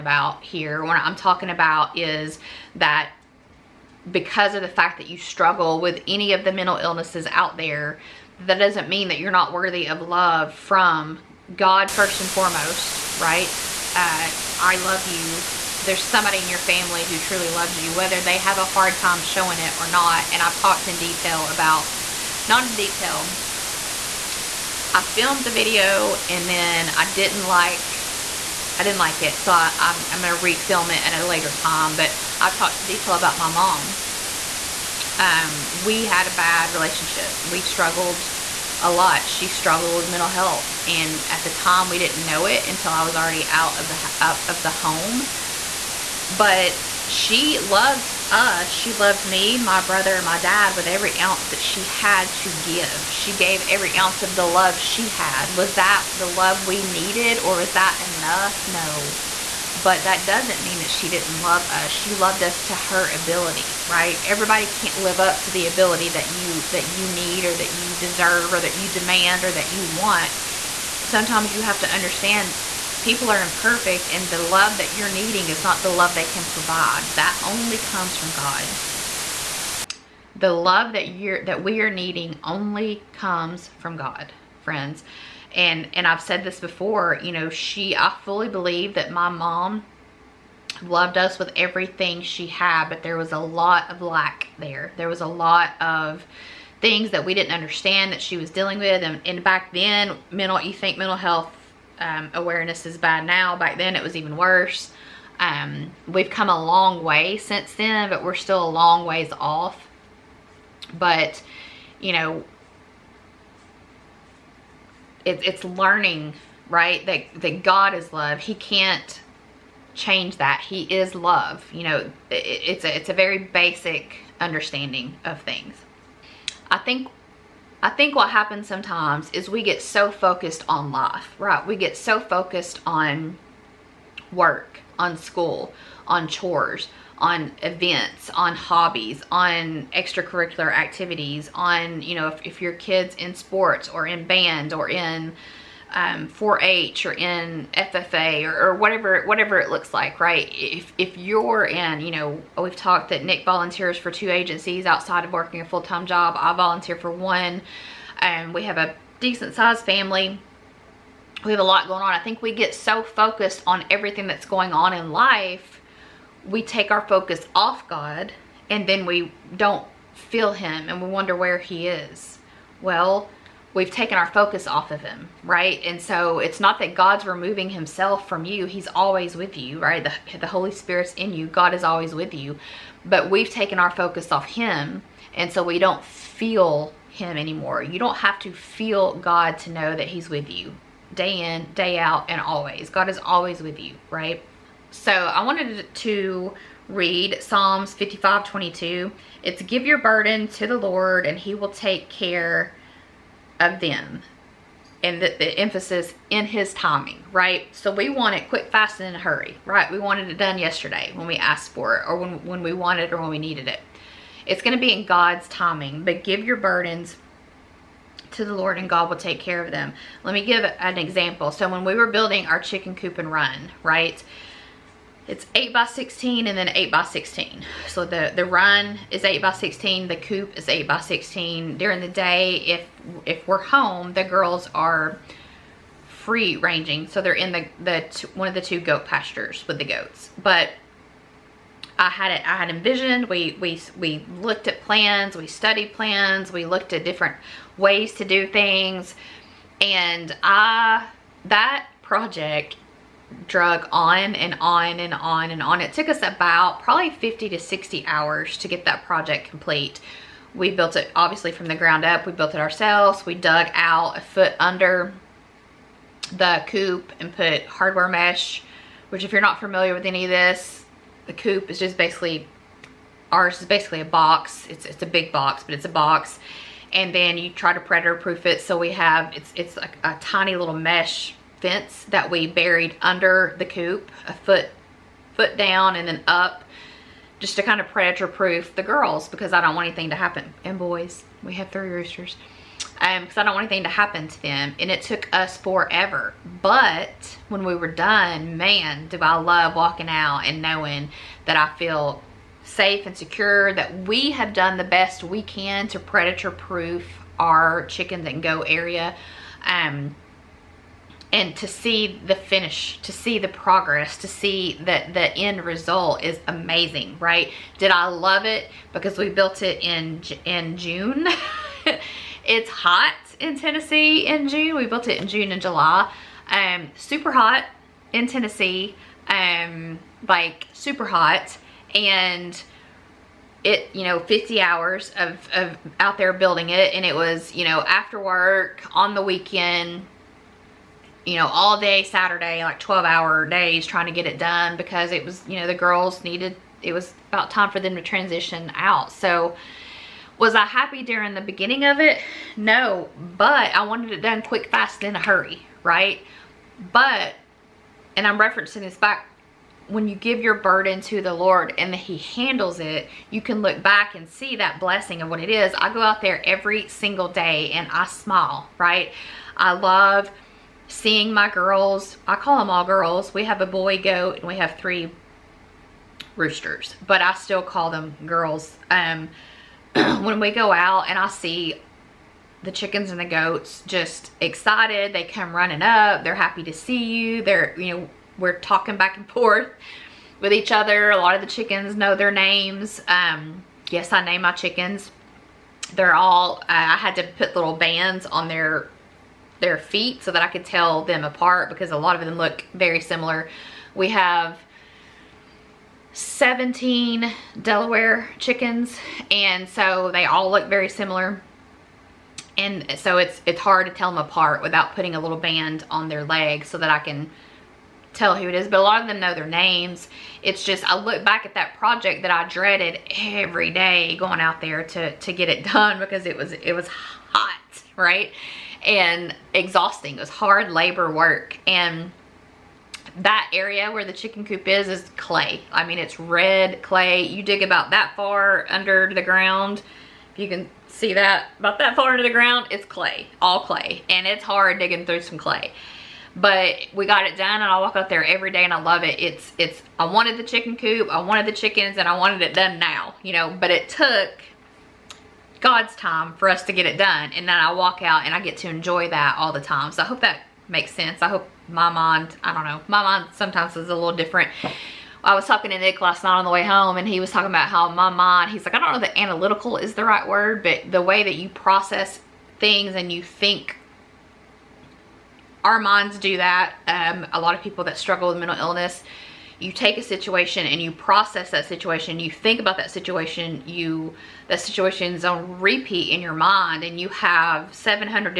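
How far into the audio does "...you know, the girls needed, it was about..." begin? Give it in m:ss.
5:45.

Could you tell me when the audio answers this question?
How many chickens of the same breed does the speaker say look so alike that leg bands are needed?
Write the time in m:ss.
6:46.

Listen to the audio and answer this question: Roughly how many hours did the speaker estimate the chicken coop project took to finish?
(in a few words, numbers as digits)
50 to 60 hours.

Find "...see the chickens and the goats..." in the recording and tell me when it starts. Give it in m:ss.
6:21.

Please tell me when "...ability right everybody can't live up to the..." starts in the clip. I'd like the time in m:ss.
1:03.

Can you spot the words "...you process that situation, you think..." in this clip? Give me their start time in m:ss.
8:00.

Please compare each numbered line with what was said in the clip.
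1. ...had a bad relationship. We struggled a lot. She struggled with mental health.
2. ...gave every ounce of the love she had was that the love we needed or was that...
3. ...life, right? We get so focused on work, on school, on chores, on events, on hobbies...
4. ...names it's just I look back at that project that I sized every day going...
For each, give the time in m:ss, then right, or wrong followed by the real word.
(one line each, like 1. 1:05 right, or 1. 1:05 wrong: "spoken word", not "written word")
1. 0:36 right
2. 0:53 right
3. 2:10 right
4. 6:59 wrong: "dreaded", not "sized".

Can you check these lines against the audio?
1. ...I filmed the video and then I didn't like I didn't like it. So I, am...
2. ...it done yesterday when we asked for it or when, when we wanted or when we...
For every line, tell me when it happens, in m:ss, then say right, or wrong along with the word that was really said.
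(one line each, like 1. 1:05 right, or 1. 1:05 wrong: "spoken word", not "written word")
1. 0:24 right
2. 3:30 right.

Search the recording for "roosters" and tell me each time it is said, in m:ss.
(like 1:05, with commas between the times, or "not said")
4:51, 6:16.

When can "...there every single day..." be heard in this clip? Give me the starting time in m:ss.
6:06.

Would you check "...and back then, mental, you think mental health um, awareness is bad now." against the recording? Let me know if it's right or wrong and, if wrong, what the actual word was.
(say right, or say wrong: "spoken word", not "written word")
right.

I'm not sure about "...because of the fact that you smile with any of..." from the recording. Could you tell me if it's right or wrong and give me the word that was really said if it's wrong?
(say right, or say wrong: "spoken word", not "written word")
wrong: "struggle", not "smile".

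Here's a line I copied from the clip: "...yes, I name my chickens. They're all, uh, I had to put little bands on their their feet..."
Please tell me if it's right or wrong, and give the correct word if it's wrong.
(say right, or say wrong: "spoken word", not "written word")
right.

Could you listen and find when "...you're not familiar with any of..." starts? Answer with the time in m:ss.
4:29.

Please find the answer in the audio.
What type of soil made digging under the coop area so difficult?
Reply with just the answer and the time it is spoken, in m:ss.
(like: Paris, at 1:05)
red clay, at 7:16.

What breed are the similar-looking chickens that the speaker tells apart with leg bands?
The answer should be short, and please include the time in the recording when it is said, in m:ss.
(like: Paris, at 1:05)
Delaware, at 6:47.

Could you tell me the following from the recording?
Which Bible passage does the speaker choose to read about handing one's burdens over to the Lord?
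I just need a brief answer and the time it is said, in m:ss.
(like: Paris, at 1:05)
Psalms 55:22, at 3:17.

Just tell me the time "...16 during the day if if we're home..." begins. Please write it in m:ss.
3:50.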